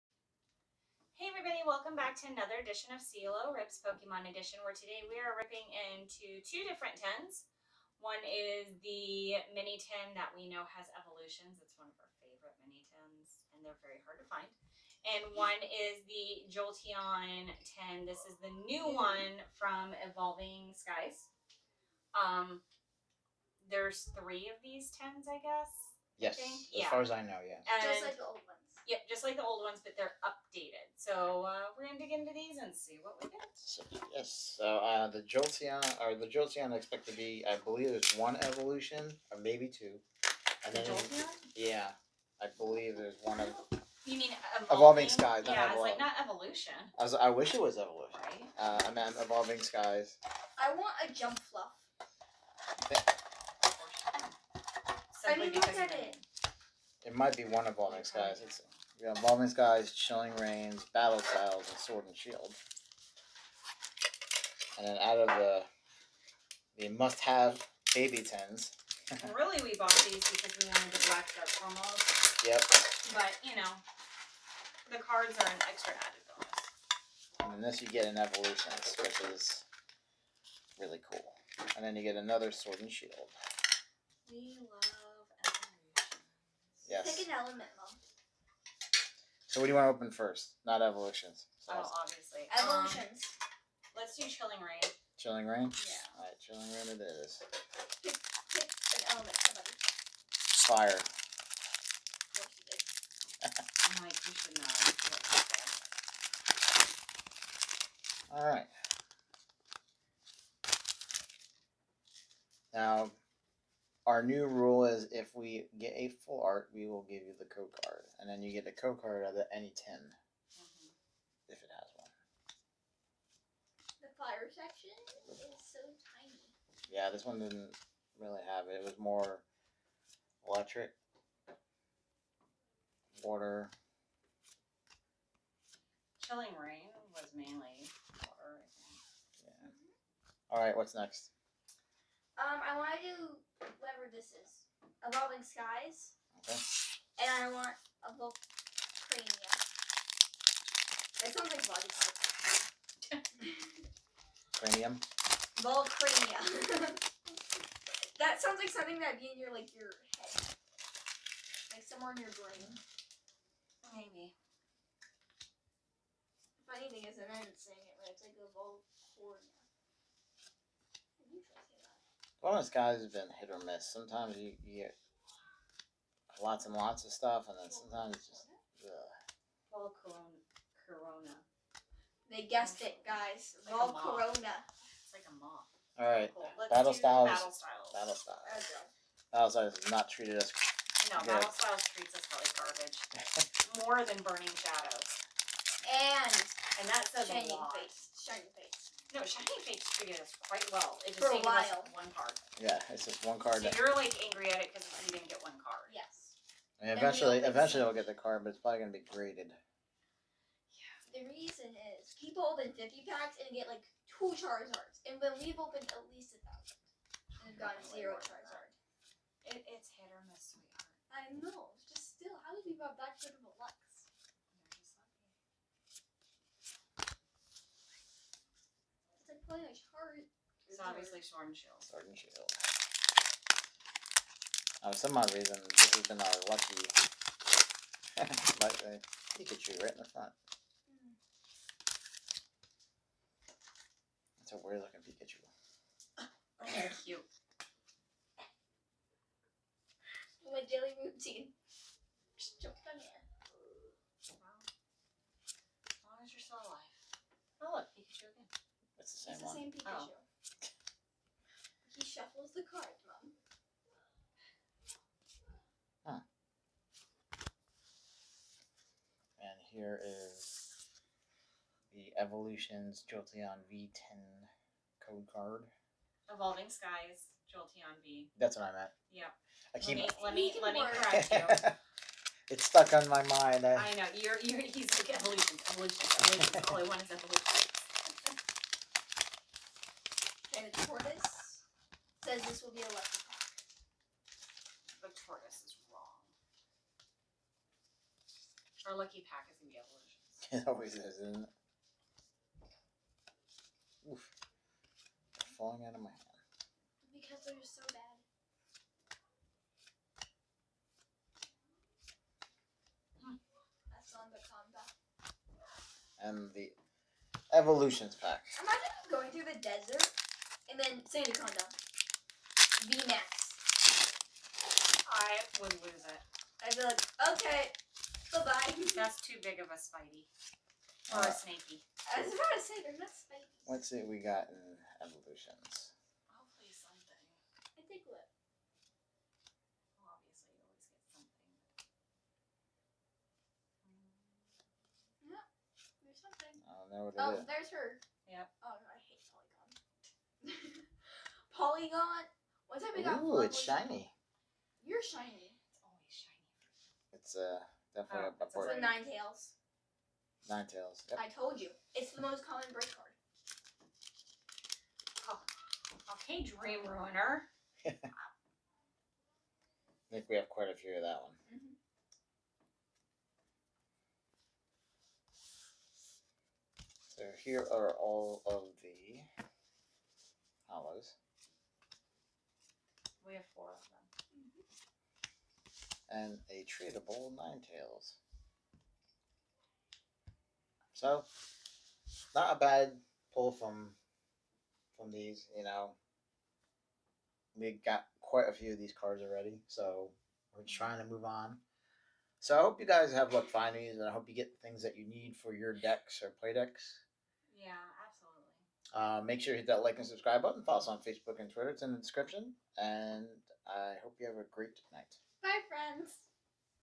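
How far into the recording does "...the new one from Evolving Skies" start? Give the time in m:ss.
0:18.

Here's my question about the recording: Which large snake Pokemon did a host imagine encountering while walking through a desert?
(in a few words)
Sandaconda VMAX.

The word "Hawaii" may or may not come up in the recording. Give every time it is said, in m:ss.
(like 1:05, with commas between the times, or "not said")
not said.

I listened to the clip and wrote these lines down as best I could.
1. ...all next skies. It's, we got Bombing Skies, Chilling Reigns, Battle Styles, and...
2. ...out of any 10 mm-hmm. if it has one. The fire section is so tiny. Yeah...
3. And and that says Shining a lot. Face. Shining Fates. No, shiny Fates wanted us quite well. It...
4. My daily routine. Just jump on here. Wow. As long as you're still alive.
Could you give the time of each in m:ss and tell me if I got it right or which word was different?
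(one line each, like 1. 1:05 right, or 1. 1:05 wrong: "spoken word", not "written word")
1. 0:57 right
2. 1:59 right
3. 3:15 wrong: "treated", not "wanted"
4. 4:10 right.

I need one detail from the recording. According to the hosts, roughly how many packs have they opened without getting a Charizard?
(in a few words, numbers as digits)
1,000.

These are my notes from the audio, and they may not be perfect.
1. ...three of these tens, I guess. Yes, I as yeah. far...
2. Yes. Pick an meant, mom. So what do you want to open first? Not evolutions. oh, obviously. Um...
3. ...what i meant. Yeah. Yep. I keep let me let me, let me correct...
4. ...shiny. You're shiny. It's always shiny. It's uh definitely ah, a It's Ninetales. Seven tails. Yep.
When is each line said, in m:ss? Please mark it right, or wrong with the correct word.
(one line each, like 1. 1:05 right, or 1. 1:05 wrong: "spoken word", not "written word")
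1. 0:24 right
2. 1:26 wrong: "element", not "meant"
3. 4:38 right
4. 5:53 wrong: "Nine", not "Seven".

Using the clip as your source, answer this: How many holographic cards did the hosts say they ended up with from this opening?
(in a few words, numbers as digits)
4.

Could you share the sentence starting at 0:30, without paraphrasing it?
So uh, we're gonna dig into these and see what we get.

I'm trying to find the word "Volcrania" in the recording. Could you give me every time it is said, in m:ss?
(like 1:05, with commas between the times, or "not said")
2:28, 2:35, 2:48.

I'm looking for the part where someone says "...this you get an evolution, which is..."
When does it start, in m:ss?
1:17.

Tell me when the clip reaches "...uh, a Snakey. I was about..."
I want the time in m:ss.
5:31.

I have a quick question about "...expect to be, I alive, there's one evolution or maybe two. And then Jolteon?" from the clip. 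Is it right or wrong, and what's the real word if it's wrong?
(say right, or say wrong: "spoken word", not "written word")
wrong: "believe", not "alive".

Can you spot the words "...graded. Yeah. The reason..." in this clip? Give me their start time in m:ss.
3:29.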